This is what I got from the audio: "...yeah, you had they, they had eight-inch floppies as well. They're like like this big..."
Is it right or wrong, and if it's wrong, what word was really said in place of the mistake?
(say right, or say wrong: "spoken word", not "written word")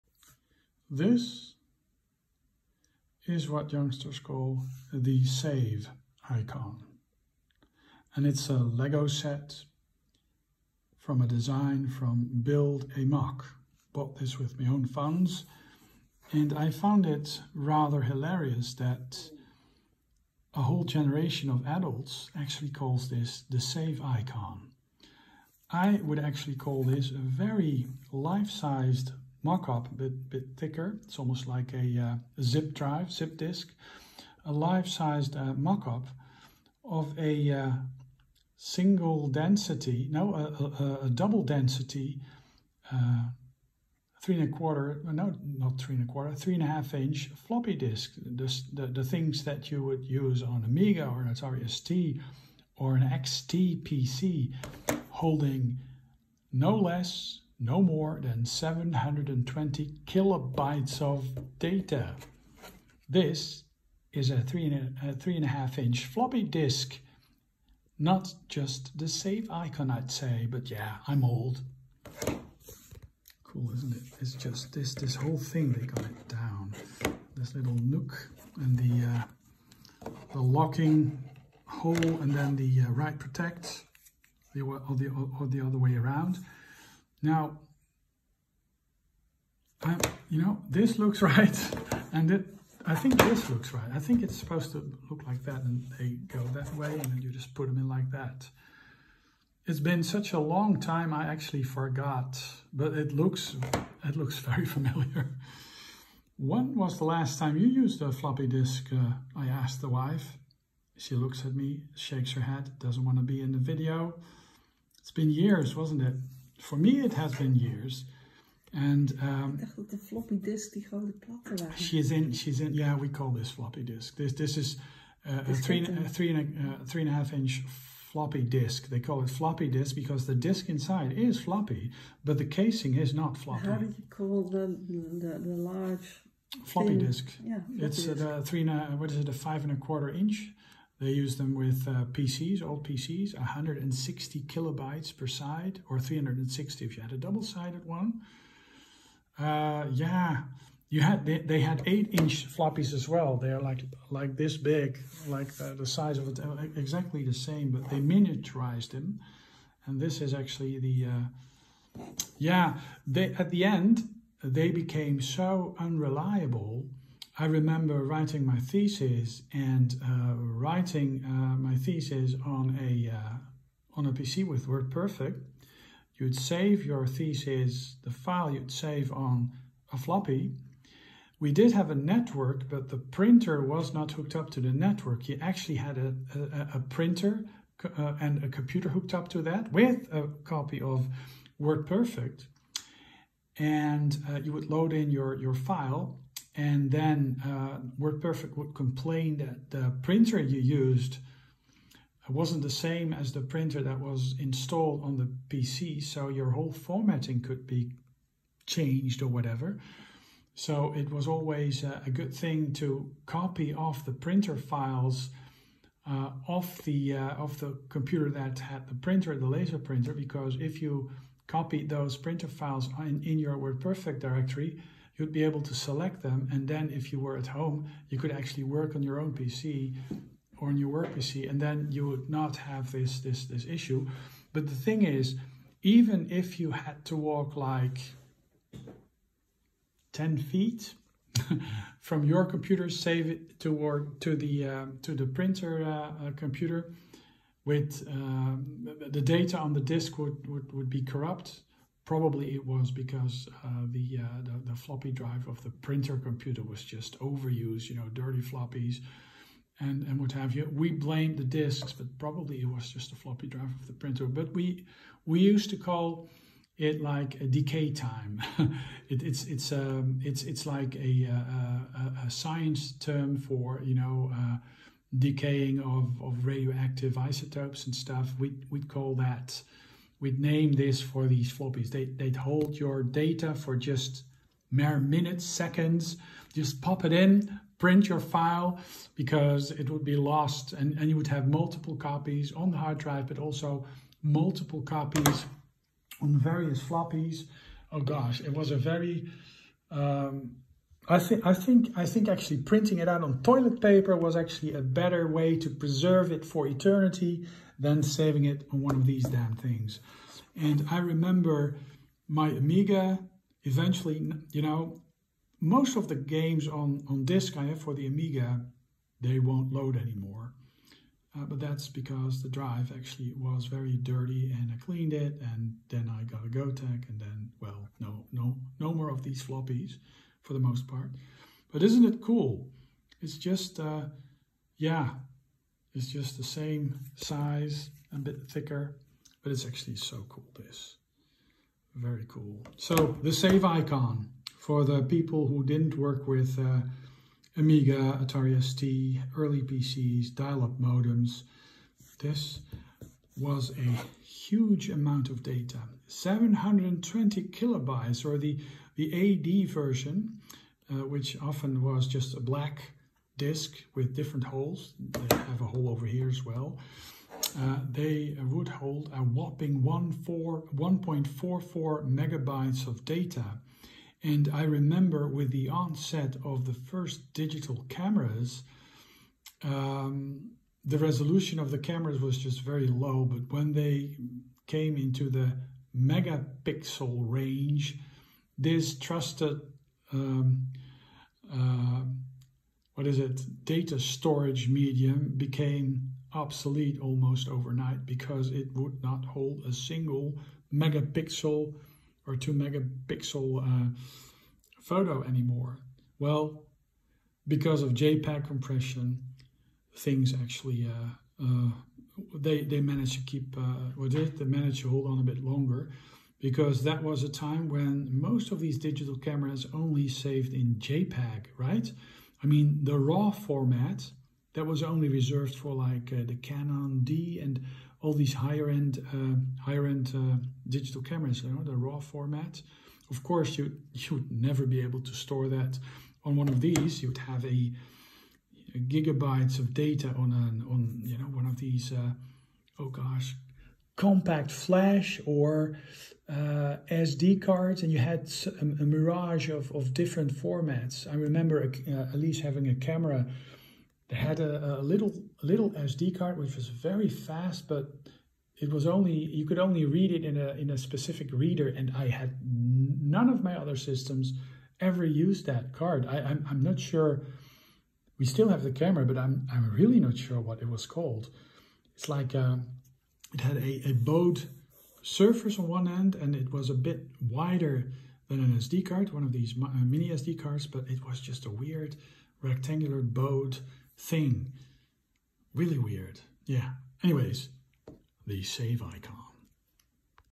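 right.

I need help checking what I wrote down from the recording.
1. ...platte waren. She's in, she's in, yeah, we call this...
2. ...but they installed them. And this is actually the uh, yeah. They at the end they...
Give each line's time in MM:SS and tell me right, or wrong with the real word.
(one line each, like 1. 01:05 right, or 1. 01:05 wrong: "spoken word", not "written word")
1. 02:00 right
2. 02:37 wrong: "miniaturized", not "installed".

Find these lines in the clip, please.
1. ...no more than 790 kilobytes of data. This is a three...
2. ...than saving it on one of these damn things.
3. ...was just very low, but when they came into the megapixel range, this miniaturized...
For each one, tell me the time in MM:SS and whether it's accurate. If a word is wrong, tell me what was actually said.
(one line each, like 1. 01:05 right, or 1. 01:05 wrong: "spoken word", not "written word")
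1. 00:57 wrong: "720", not "790"
2. 05:07 right
3. 06:22 wrong: "trusted", not "miniaturized".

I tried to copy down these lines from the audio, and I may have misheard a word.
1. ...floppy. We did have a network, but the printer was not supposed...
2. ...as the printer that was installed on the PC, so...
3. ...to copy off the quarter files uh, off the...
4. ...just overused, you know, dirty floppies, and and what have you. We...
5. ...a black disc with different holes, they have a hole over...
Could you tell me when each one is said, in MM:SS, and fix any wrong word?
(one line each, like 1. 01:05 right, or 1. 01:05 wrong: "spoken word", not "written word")
1. 02:59 wrong: "hooked", not "supposed"
2. 03:23 right
3. 03:32 wrong: "printer", not "quarter"
4. 04:16 right
5. 06:02 right.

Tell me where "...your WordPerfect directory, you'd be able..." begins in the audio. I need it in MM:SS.
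03:43.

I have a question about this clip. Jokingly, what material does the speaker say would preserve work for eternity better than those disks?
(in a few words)
toilet paper.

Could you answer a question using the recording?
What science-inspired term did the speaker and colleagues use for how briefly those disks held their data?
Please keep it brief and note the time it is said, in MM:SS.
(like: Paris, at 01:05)
decay time, at 04:27.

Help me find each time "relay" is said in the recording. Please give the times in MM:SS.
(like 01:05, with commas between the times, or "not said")
not said.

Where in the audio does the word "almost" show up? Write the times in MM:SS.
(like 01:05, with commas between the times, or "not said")
00:31, 06:37.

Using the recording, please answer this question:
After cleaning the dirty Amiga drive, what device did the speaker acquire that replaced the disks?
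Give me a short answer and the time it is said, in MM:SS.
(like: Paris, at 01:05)
Gotek, at 05:26.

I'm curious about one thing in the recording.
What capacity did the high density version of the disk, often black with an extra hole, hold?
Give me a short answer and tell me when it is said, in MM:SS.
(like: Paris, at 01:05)
1.44 megabytes, at 06:09.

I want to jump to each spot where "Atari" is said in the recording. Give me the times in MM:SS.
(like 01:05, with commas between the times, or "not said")
00:51, 05:48.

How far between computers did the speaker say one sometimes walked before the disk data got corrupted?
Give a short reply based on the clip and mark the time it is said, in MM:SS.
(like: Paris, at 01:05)
10 feet, at 04:00.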